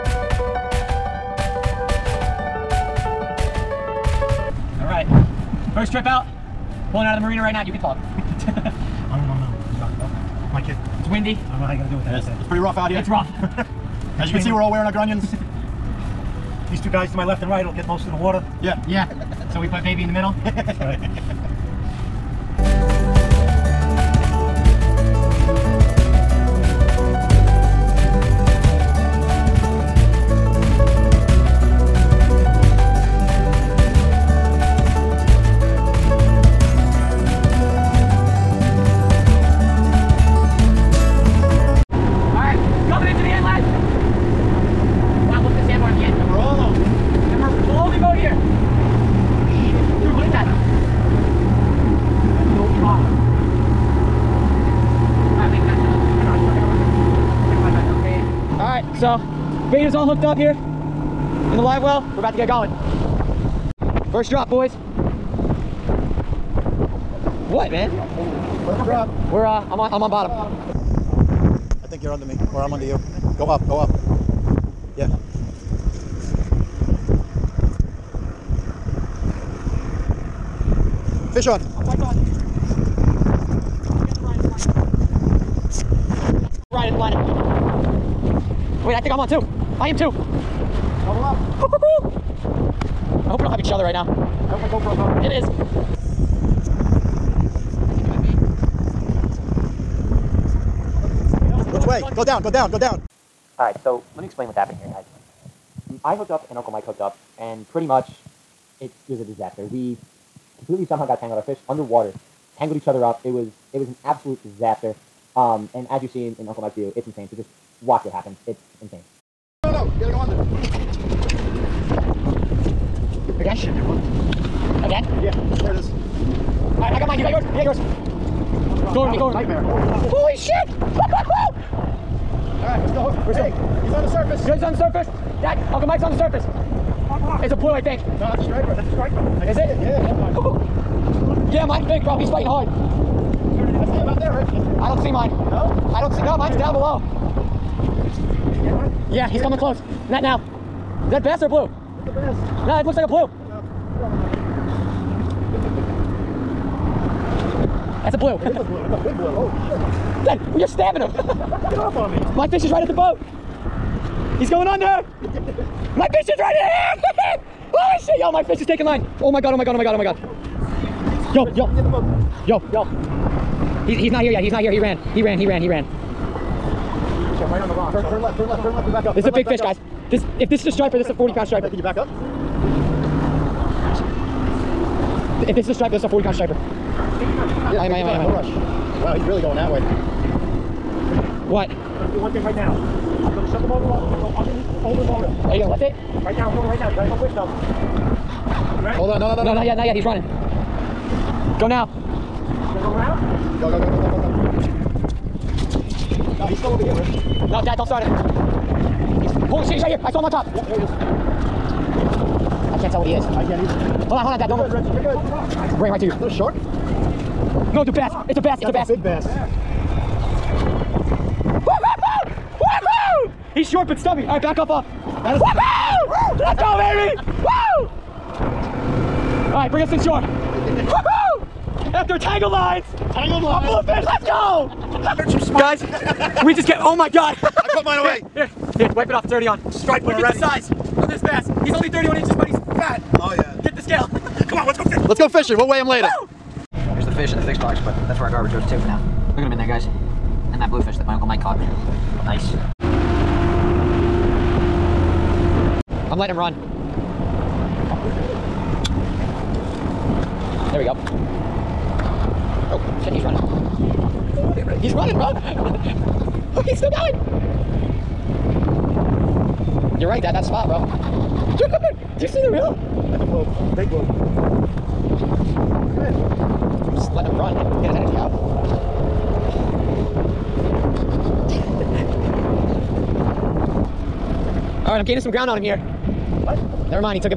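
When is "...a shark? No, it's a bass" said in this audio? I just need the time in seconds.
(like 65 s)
216 s.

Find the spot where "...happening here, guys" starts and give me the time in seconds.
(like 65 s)
104 s.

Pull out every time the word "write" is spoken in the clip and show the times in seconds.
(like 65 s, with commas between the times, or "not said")
not said.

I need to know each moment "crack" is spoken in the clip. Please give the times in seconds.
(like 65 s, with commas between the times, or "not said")
not said.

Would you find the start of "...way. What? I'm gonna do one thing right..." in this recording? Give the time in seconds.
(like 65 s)
189 s.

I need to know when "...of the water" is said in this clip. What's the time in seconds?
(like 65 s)
18 s.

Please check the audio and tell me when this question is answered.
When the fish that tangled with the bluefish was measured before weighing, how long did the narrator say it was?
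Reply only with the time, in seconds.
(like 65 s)
241 s.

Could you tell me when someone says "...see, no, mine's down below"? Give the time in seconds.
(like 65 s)
146 s.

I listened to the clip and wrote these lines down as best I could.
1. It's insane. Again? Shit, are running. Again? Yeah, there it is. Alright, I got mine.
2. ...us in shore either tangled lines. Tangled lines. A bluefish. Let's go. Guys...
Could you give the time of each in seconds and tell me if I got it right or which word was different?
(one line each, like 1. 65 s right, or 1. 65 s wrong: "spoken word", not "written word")
1. 118 s right
2. 229 s wrong: "after", not "either".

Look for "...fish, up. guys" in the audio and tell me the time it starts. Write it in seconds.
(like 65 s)
179 s.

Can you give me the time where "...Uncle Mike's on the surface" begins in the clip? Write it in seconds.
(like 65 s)
135 s.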